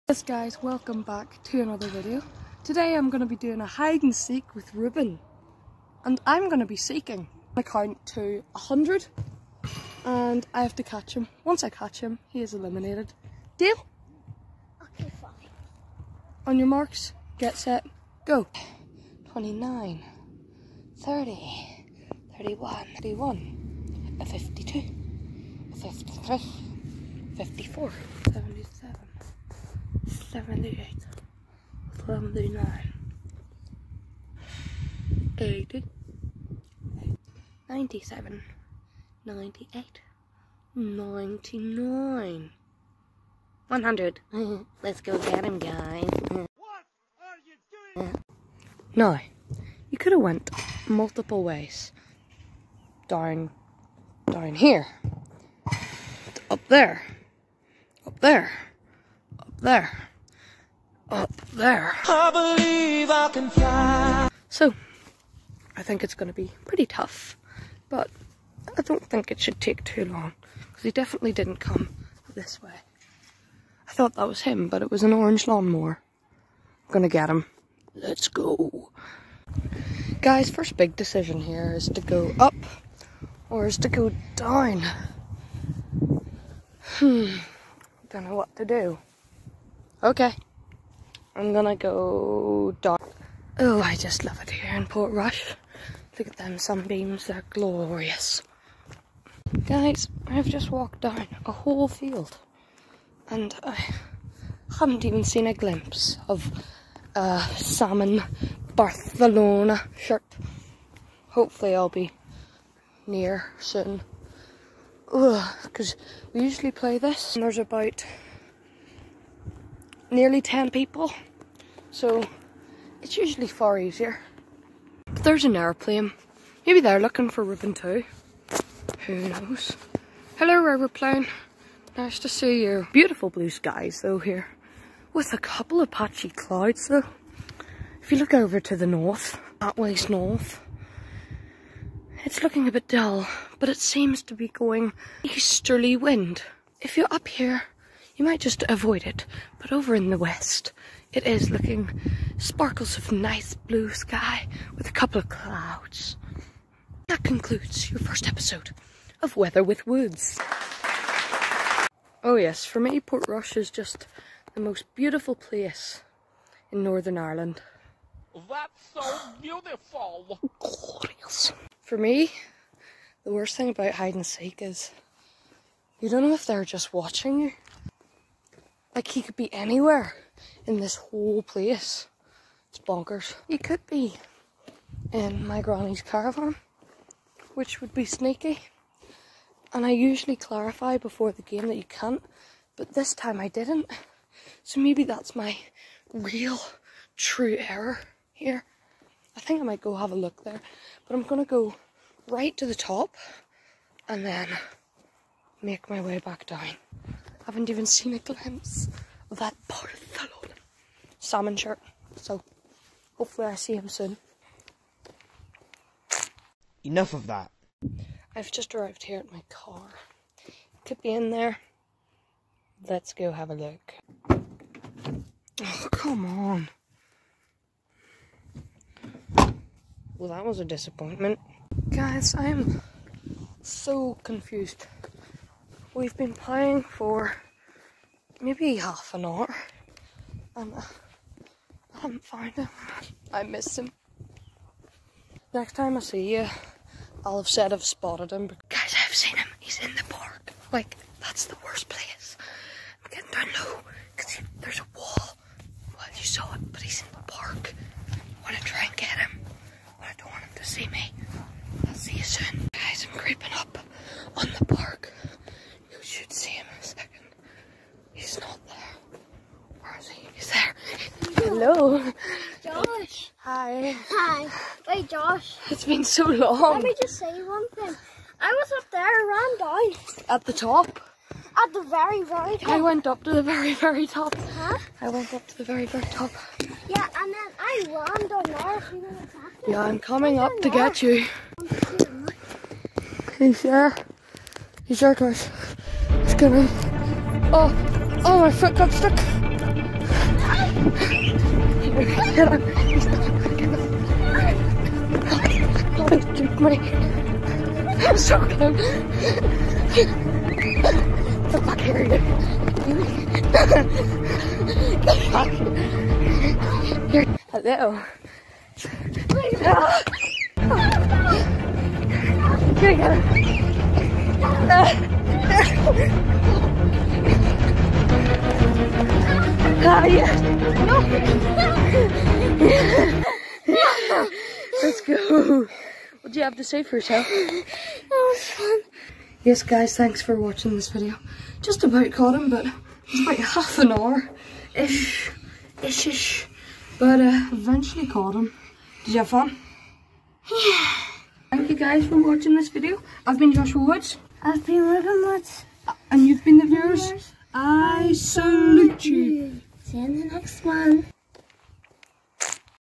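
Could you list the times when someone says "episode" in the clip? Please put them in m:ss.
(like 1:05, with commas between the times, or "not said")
2:38.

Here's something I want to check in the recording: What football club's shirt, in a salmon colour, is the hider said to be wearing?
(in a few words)
Barcelona.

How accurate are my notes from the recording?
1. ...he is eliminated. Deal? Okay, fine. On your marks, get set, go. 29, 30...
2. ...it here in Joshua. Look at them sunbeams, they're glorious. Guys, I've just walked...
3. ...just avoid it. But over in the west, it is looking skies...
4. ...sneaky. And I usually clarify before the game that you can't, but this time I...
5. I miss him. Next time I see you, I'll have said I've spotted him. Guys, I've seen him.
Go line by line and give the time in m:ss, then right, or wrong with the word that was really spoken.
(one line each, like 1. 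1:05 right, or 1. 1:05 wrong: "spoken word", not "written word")
1. 0:12 right
2. 1:34 wrong: "Portrush", not "Joshua"
3. 2:28 wrong: "sparkles", not "skies"
4. 3:08 right
5. 4:03 right.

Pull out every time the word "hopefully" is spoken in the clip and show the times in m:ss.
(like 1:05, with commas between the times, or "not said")
1:51, 3:33.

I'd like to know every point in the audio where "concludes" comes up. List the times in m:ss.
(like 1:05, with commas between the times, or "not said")
2:37.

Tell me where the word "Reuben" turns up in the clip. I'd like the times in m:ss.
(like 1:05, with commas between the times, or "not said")
0:04, 2:07, 5:54.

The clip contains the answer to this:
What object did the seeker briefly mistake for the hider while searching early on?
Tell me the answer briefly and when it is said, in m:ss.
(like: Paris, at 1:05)
orange lawnmower, at 1:15.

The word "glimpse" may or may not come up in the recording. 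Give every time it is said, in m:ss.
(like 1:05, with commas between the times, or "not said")
1:45, 3:28.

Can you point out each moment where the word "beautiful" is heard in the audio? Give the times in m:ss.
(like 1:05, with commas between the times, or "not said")
2:12, 2:44, 2:49.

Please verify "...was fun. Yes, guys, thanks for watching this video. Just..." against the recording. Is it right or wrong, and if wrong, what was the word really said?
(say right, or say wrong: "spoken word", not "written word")
right.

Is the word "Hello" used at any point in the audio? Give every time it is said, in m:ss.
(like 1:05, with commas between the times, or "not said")
2:10, 5:17.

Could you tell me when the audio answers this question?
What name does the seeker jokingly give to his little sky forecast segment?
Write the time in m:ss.
2:39.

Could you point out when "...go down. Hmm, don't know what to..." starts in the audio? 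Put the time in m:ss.
1:23.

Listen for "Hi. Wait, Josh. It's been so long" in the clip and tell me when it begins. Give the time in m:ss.
4:34.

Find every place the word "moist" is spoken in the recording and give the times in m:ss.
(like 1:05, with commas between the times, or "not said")
not said.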